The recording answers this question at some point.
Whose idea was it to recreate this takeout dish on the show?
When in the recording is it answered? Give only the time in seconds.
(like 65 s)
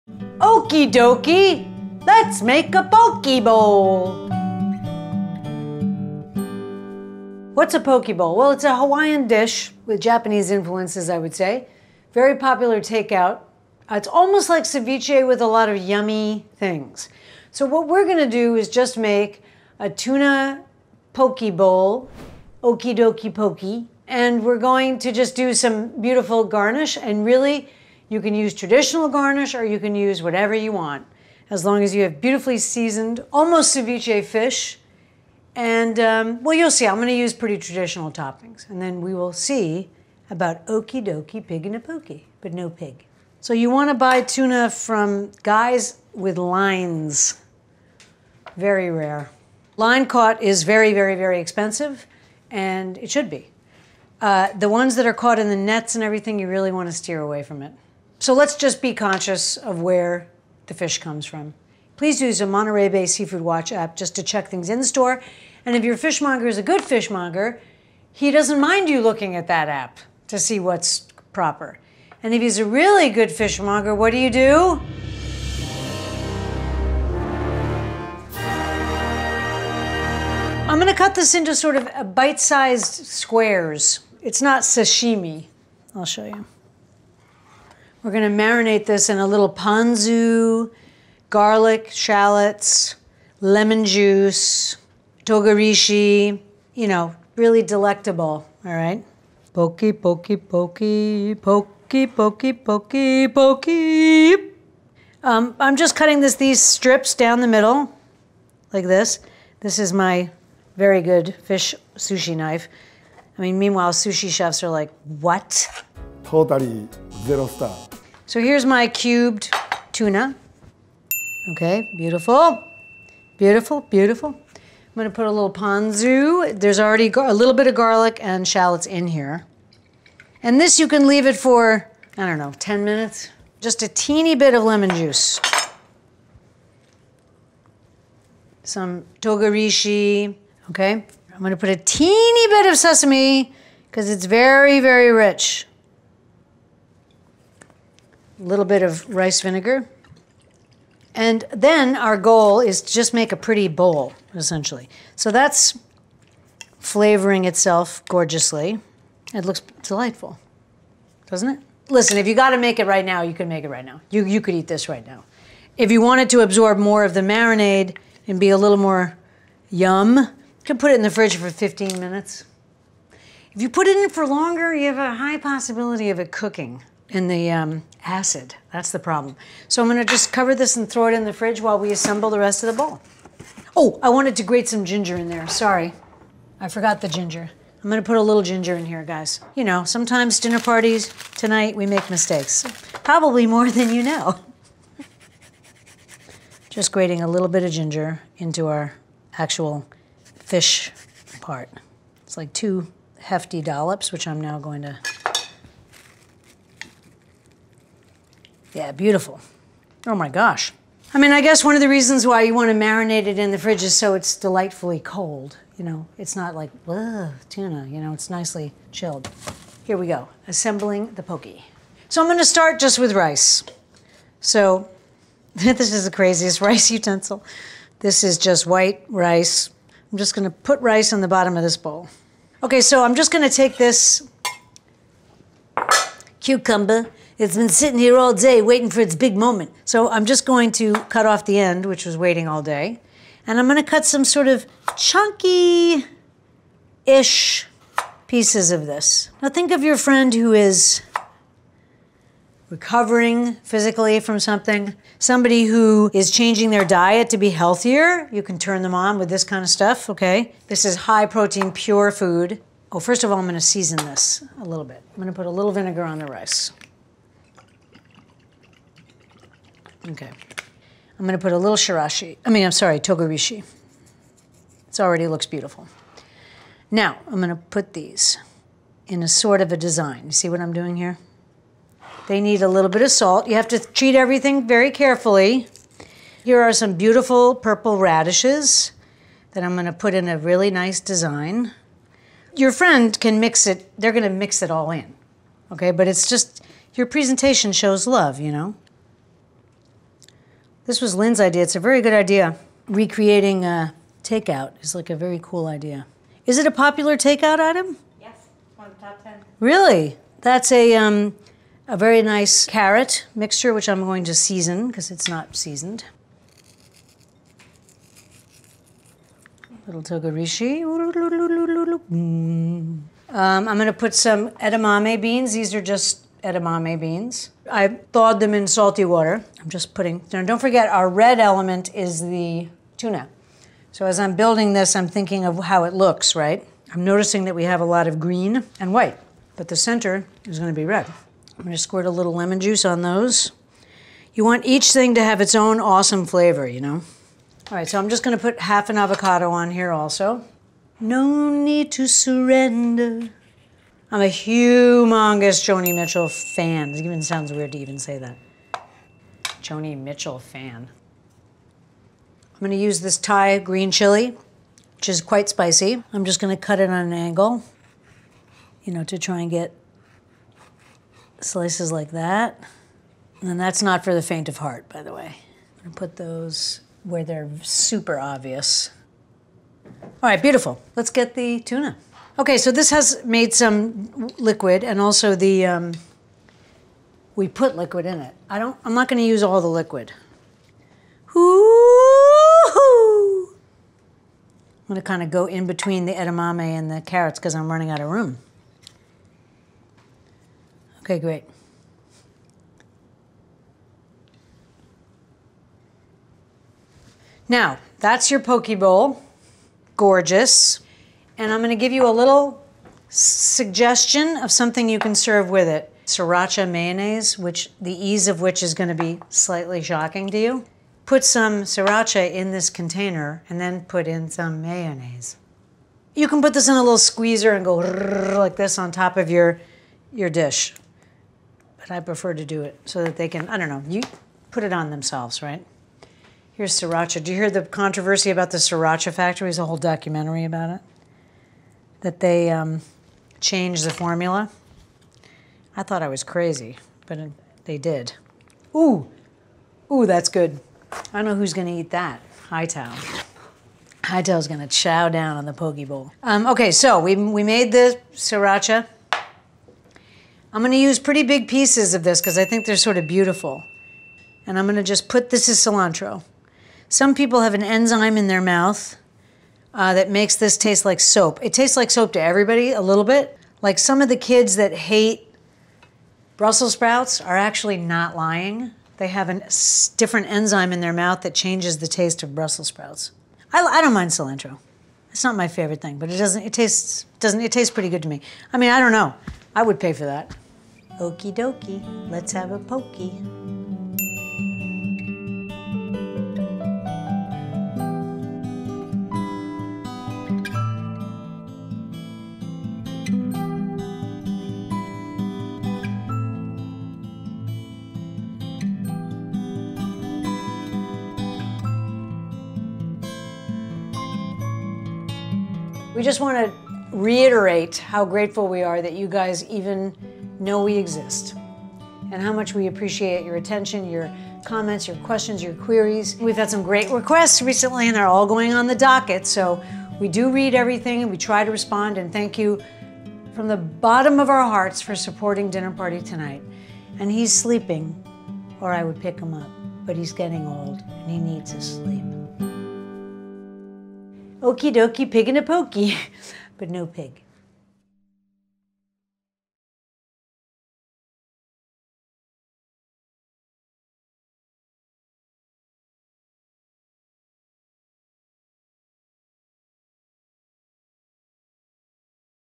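301 s.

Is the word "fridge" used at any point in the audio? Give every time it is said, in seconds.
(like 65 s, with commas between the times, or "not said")
171 s, 181 s, 213 s.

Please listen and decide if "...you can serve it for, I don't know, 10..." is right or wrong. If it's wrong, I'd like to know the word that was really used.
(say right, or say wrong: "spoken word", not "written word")
wrong: "leave", not "serve".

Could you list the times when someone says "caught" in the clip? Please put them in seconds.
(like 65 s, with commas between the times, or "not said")
50 s, 55 s.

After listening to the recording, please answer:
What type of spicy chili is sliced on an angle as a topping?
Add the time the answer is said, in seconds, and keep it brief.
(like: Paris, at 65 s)
Thai green chili, at 363 s.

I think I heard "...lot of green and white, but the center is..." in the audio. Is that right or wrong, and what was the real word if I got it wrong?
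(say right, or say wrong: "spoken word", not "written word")
right.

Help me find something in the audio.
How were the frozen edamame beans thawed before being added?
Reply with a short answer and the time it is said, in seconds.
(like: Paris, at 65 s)
in salty water, at 328 s.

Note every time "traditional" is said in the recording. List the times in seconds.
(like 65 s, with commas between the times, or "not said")
28 s, 37 s.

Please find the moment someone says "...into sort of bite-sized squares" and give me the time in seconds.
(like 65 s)
81 s.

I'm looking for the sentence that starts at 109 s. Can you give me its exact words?
This is my very good fish sushi knife.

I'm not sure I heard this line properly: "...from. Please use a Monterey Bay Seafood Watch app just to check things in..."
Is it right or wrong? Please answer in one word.
right.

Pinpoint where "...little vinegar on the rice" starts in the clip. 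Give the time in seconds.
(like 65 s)
265 s.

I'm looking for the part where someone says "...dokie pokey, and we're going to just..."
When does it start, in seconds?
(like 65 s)
22 s.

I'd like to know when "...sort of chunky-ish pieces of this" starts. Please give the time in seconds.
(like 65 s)
244 s.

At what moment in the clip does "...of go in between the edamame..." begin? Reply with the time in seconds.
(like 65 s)
395 s.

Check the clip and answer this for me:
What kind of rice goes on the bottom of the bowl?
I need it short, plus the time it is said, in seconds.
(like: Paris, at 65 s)
white rice, at 228 s.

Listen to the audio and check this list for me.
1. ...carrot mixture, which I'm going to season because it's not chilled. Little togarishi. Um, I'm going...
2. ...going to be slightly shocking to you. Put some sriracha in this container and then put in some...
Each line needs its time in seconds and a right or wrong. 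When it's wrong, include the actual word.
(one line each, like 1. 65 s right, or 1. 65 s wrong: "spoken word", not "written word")
1. 312 s wrong: "seasoned", not "chilled"
2. 418 s right.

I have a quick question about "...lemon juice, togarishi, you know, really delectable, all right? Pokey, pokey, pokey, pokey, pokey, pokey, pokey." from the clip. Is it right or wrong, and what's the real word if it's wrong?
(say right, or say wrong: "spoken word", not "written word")
right.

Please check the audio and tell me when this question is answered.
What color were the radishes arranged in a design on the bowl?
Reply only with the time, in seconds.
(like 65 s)
287 s.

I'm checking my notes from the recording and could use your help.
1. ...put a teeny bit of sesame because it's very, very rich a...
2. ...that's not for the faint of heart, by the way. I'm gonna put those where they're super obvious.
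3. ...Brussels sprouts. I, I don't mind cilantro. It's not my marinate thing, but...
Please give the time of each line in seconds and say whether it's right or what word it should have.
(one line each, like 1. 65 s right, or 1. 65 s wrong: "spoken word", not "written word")
1. 141 s right
2. 373 s right
3. 482 s wrong: "favorite", not "marinate".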